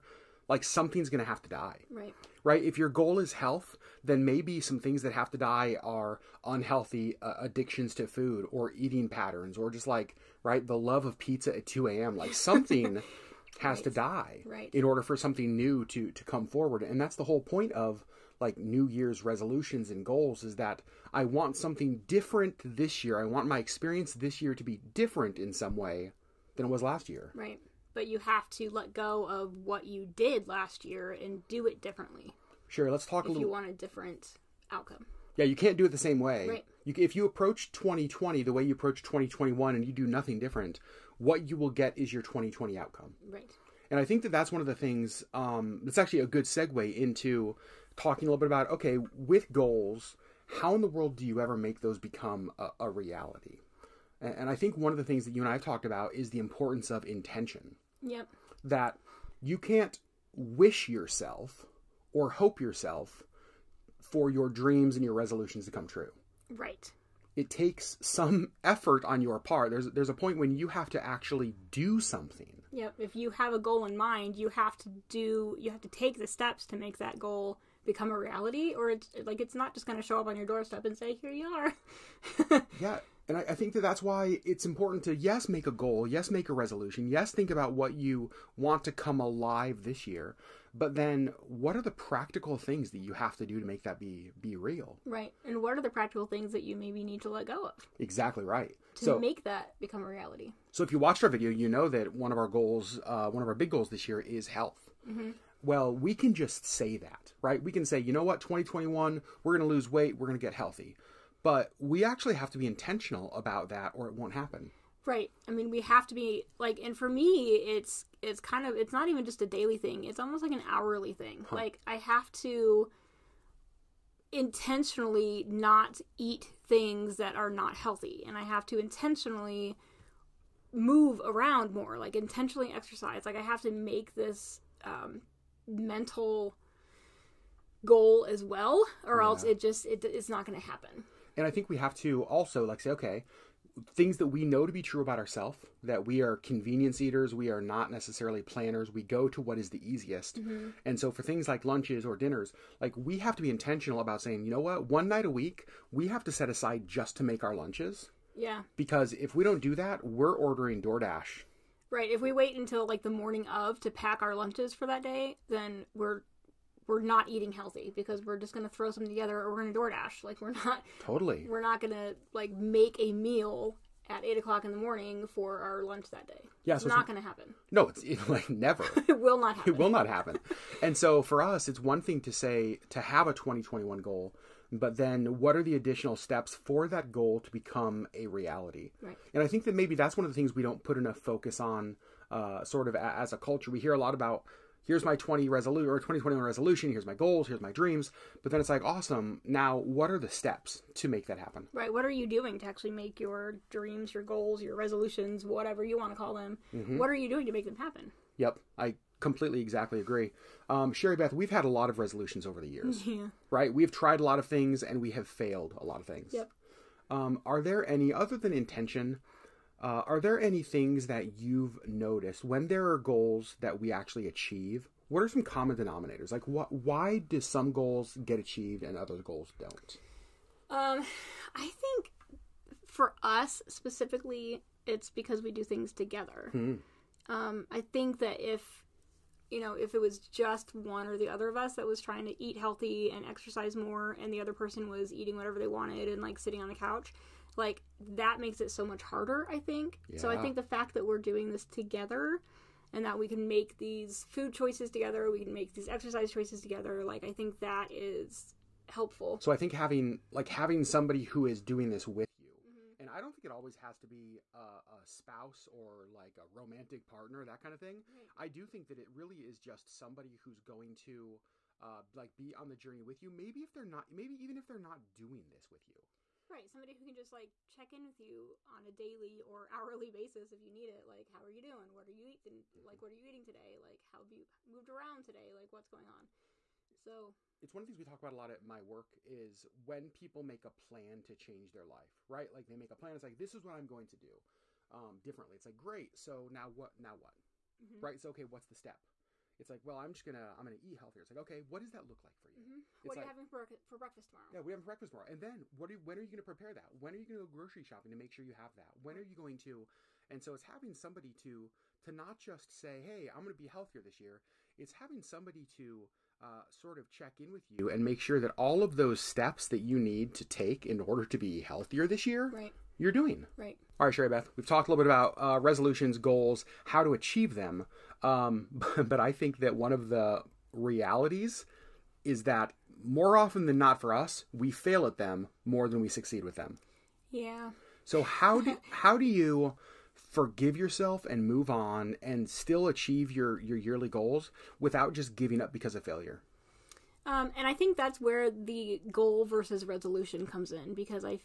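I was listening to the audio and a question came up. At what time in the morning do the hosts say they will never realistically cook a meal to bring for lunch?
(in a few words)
8 o'clock.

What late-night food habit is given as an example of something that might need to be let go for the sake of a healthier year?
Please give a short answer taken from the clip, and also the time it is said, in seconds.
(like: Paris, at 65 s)
pizza at 2 a.m., at 11 s.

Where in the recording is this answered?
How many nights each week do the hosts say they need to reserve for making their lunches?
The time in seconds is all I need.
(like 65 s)
154 s.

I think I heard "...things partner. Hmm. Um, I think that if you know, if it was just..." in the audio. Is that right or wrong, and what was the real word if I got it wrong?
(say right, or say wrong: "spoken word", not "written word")
wrong: "together", not "partner".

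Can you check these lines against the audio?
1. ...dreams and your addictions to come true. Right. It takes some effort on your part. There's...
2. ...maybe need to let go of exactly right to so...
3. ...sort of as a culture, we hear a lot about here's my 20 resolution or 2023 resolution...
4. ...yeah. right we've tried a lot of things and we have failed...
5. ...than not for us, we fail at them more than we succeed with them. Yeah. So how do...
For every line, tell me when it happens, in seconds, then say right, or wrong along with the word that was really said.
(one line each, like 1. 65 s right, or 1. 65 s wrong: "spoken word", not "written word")
1. 64 s wrong: "resolutions", not "addictions"
2. 96 s right
3. 192 s wrong: "2021", not "2023"
4. 213 s right
5. 333 s right.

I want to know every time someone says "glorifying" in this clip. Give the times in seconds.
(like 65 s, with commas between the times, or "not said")
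not said.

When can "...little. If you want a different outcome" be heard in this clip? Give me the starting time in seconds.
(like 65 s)
33 s.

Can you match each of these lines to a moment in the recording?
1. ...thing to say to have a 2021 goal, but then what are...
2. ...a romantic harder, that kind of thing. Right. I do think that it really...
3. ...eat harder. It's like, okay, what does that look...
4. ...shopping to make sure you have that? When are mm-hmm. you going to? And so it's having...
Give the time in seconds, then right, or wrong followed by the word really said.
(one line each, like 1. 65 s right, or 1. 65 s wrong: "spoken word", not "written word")
1. 182 s right
2. 266 s wrong: "partner", not "harder"
3. 300 s wrong: "healthier", not "harder"
4. 307 s right.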